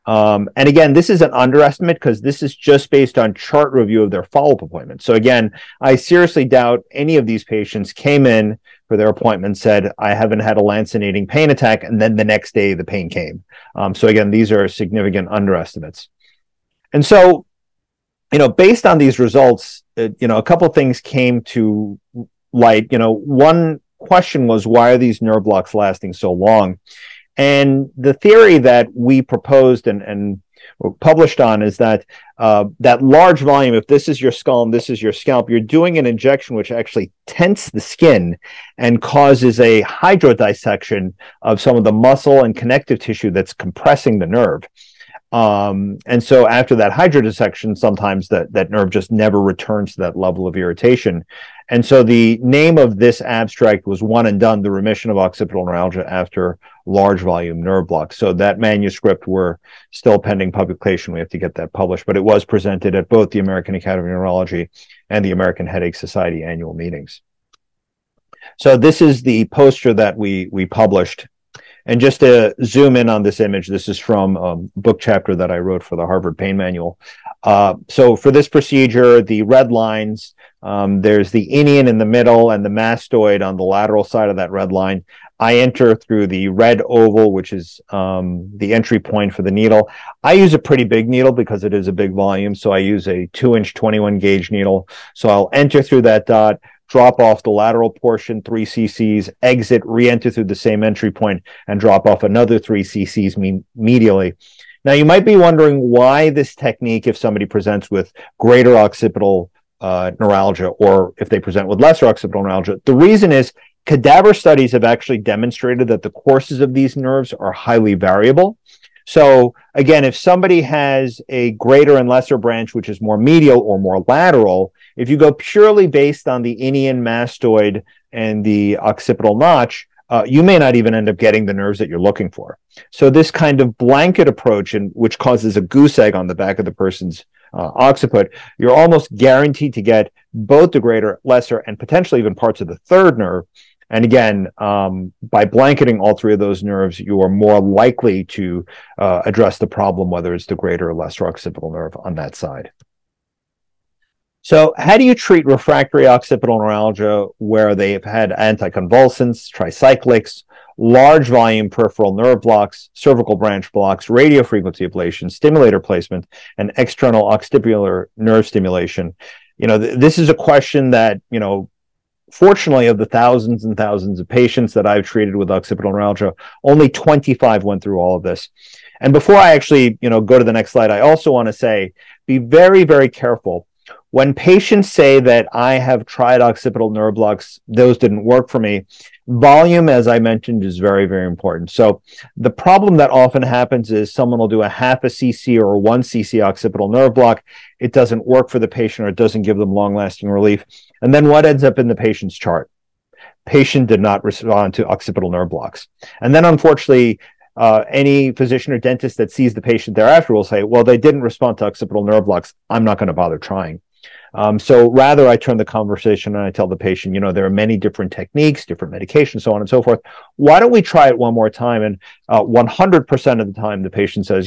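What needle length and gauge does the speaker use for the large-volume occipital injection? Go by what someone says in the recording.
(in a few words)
2 inch 21 gauge.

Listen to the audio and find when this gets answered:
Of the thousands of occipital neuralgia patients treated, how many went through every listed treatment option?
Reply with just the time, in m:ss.
2:56.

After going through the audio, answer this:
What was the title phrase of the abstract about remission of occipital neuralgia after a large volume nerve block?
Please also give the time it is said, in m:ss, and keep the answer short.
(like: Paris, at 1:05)
One and Done, at 0:54.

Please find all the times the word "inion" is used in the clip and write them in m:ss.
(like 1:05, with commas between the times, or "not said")
1:21, 2:06.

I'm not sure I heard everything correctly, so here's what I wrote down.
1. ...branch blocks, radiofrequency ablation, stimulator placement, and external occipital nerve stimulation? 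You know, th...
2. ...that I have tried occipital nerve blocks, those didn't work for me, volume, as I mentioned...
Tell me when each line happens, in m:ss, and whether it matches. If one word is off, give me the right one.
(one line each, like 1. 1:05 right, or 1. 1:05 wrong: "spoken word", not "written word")
1. 2:43 right
2. 3:05 right.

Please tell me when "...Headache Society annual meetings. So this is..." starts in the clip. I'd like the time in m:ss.
1:05.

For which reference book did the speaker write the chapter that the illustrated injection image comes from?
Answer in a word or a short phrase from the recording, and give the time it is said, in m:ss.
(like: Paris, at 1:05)
Harvard Pain Manual, at 1:16.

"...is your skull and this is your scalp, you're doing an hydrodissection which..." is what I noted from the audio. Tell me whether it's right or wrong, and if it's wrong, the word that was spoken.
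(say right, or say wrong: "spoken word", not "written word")
wrong: "injection", not "hydrodissection".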